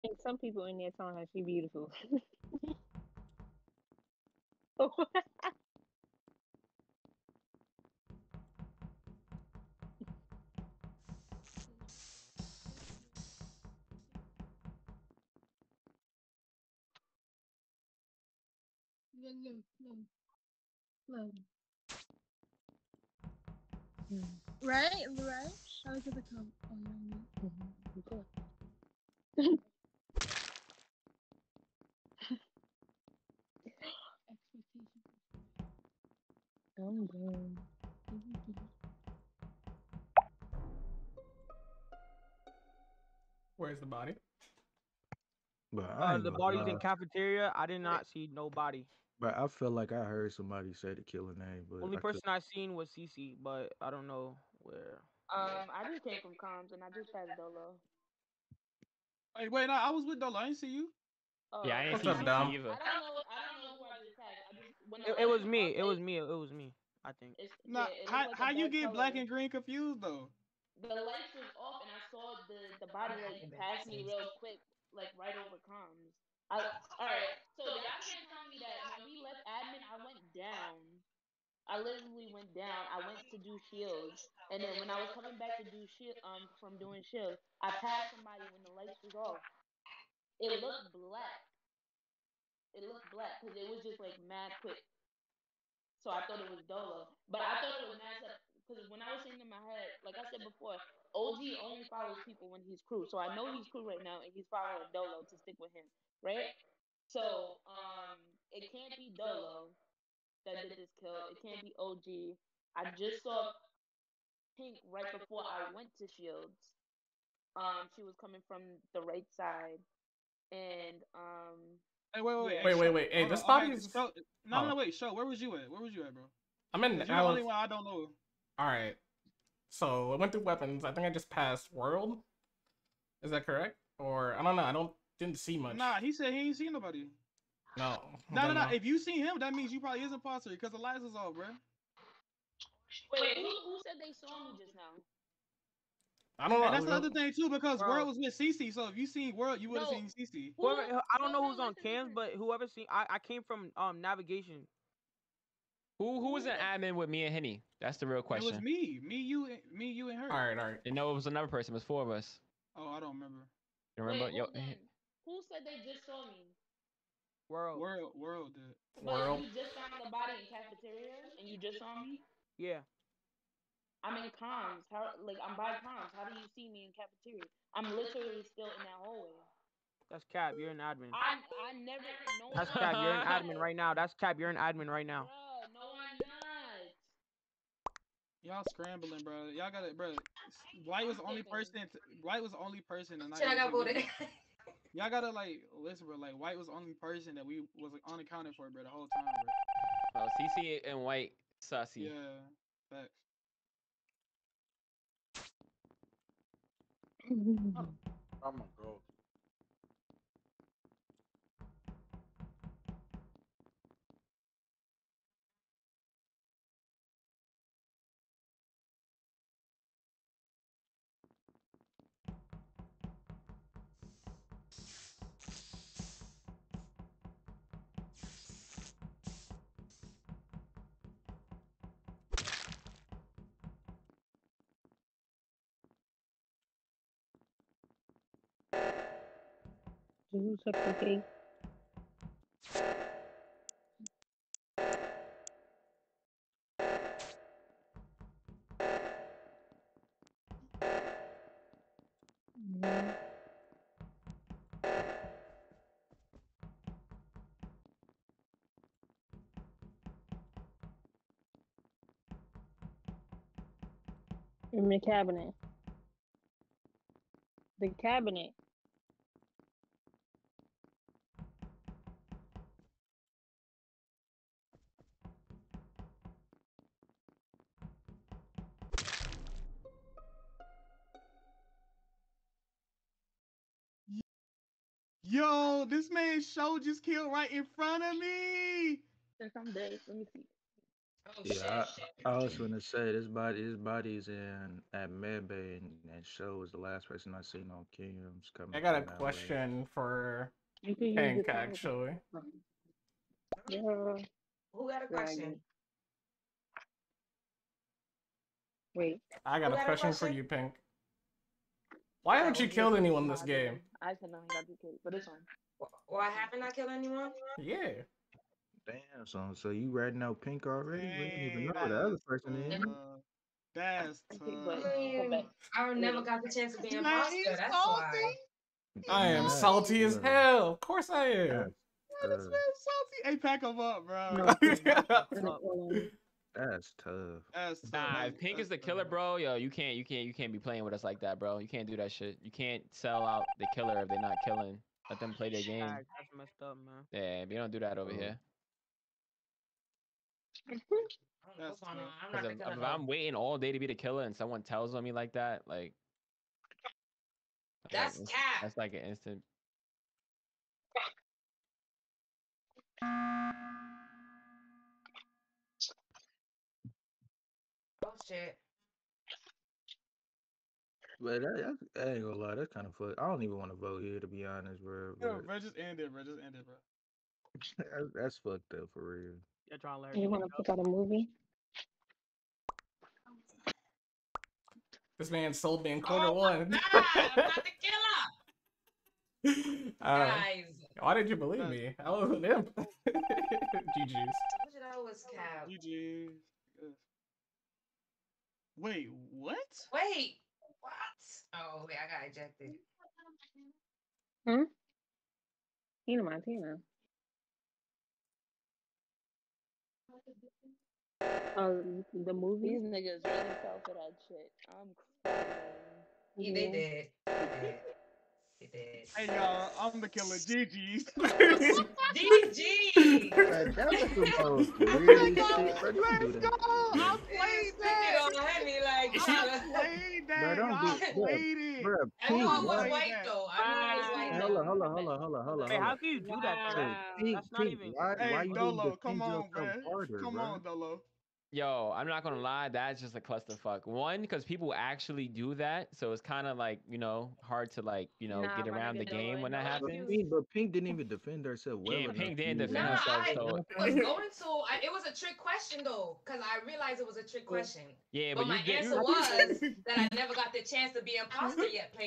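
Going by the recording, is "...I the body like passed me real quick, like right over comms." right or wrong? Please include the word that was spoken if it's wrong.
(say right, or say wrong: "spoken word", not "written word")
right.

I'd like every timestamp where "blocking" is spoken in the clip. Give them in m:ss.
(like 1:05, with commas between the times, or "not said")
not said.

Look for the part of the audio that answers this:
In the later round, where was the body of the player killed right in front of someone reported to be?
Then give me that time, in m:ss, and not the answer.
4:53.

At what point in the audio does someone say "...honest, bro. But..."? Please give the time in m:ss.
6:14.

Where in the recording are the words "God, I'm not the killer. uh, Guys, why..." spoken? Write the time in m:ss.
6:26.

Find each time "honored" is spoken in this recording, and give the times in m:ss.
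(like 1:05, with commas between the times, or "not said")
not said.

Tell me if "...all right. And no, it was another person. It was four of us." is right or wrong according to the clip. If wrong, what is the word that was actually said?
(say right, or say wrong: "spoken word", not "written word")
right.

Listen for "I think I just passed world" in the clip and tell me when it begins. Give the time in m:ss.
2:10.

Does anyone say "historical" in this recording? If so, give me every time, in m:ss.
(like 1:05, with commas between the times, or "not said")
not said.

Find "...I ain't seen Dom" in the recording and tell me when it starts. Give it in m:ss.
1:01.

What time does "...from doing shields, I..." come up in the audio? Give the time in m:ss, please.
1:26.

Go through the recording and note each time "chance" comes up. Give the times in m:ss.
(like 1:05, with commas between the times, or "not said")
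5:26, 7:40.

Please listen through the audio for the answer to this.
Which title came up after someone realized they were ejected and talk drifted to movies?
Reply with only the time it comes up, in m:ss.
6:46.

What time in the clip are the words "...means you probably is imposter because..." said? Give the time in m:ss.
2:19.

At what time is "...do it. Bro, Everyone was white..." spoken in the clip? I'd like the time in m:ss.
7:10.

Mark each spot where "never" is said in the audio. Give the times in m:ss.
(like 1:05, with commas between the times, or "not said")
3:01, 5:25, 7:40.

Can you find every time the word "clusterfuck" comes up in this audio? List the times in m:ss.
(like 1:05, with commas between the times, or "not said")
7:23.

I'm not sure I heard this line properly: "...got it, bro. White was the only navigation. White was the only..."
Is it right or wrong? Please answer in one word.
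wrong.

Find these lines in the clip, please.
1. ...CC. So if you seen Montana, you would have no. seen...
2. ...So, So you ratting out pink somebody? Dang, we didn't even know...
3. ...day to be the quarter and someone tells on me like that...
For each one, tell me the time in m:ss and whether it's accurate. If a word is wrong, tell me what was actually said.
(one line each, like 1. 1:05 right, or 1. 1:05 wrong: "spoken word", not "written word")
1. 2:28 wrong: "World", not "Montana"
2. 5:19 wrong: "already", not "somebody"
3. 5:53 wrong: "killer", not "quarter".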